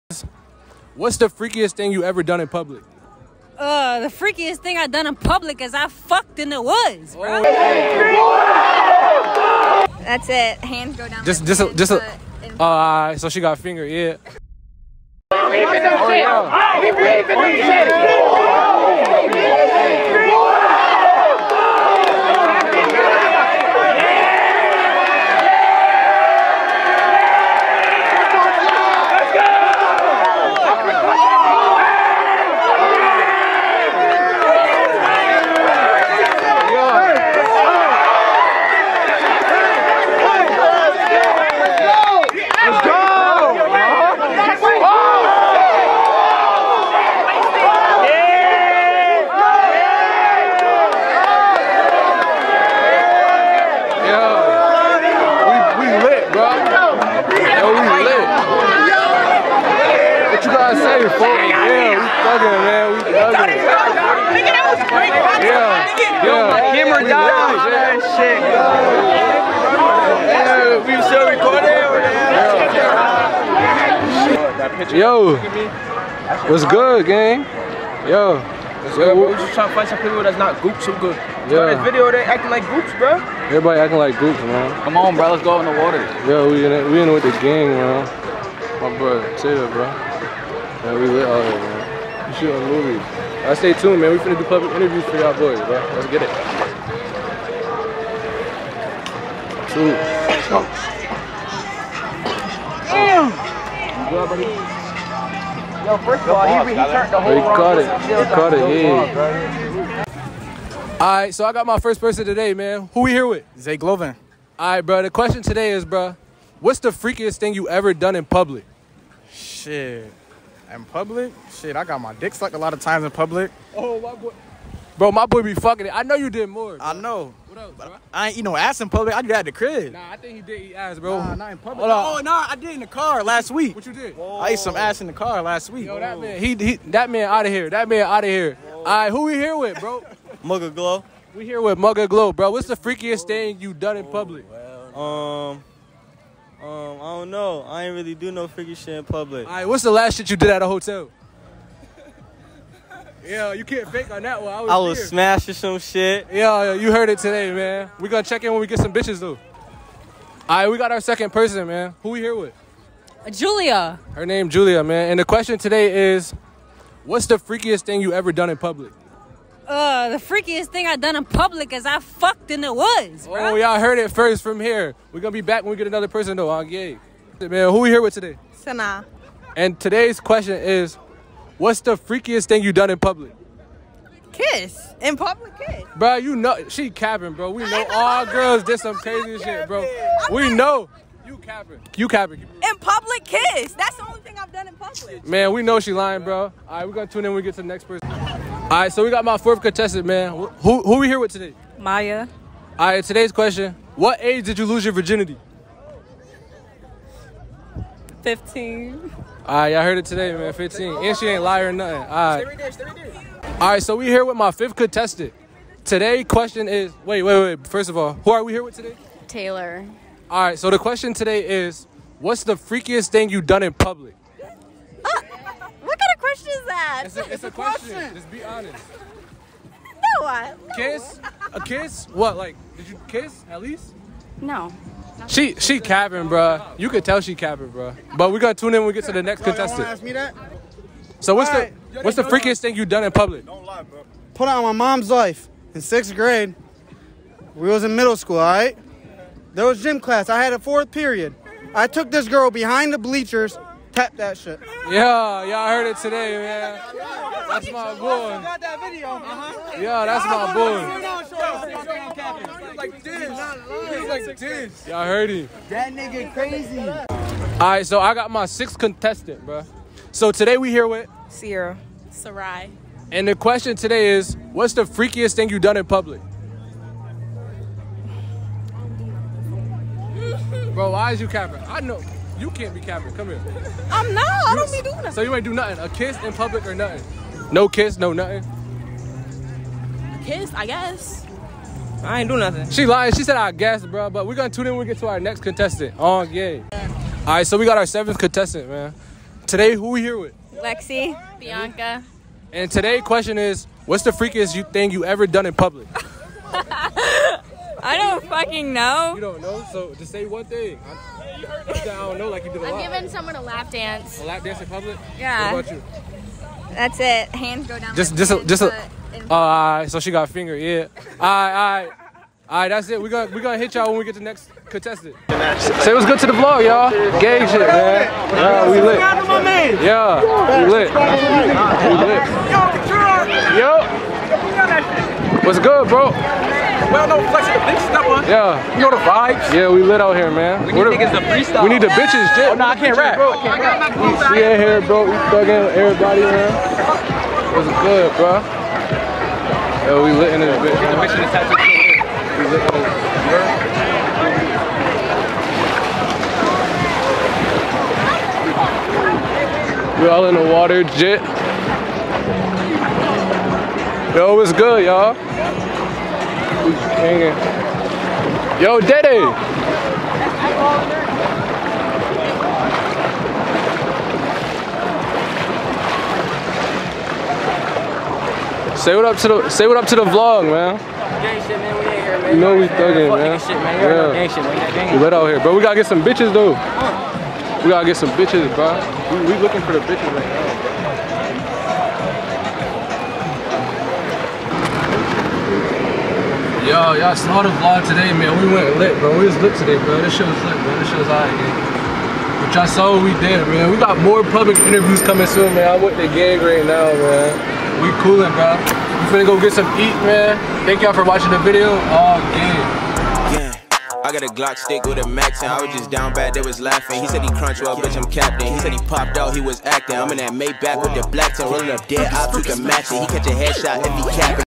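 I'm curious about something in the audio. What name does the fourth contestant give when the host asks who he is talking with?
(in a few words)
Maya.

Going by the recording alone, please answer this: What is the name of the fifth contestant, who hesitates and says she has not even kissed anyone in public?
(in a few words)
Taylor.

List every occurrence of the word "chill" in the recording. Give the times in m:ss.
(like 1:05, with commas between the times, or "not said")
1:29.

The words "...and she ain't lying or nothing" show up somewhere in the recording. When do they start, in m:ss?
3:31.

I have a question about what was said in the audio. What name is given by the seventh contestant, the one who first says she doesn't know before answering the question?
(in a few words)
Lexi Bianca.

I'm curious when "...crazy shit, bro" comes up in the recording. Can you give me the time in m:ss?
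3:08.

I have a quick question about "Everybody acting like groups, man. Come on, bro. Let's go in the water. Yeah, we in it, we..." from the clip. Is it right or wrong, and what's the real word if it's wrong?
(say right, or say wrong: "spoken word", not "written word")
right.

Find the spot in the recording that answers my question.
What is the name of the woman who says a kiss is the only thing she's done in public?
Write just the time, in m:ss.
2:58.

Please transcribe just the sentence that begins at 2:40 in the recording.
All right, we got our second person, man.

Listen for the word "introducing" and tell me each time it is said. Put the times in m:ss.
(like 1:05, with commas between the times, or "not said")
not said.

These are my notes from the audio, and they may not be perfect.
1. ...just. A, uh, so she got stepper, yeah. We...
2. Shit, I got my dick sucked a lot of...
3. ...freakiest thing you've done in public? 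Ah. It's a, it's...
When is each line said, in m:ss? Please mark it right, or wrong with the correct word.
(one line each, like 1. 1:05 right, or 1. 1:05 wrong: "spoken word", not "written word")
1. 0:11 wrong: "finger", not "stepper"
2. 2:01 right
3. 3:42 right.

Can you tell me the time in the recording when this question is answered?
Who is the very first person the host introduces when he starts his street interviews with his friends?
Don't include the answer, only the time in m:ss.
1:53.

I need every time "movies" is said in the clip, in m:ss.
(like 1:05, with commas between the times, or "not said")
1:32.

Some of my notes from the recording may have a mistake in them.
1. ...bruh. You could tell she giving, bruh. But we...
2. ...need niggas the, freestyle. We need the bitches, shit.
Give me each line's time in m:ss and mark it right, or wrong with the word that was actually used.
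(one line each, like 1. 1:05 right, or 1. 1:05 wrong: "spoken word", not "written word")
1. 3:56 wrong: "capping", not "giving"
2. 5:40 right.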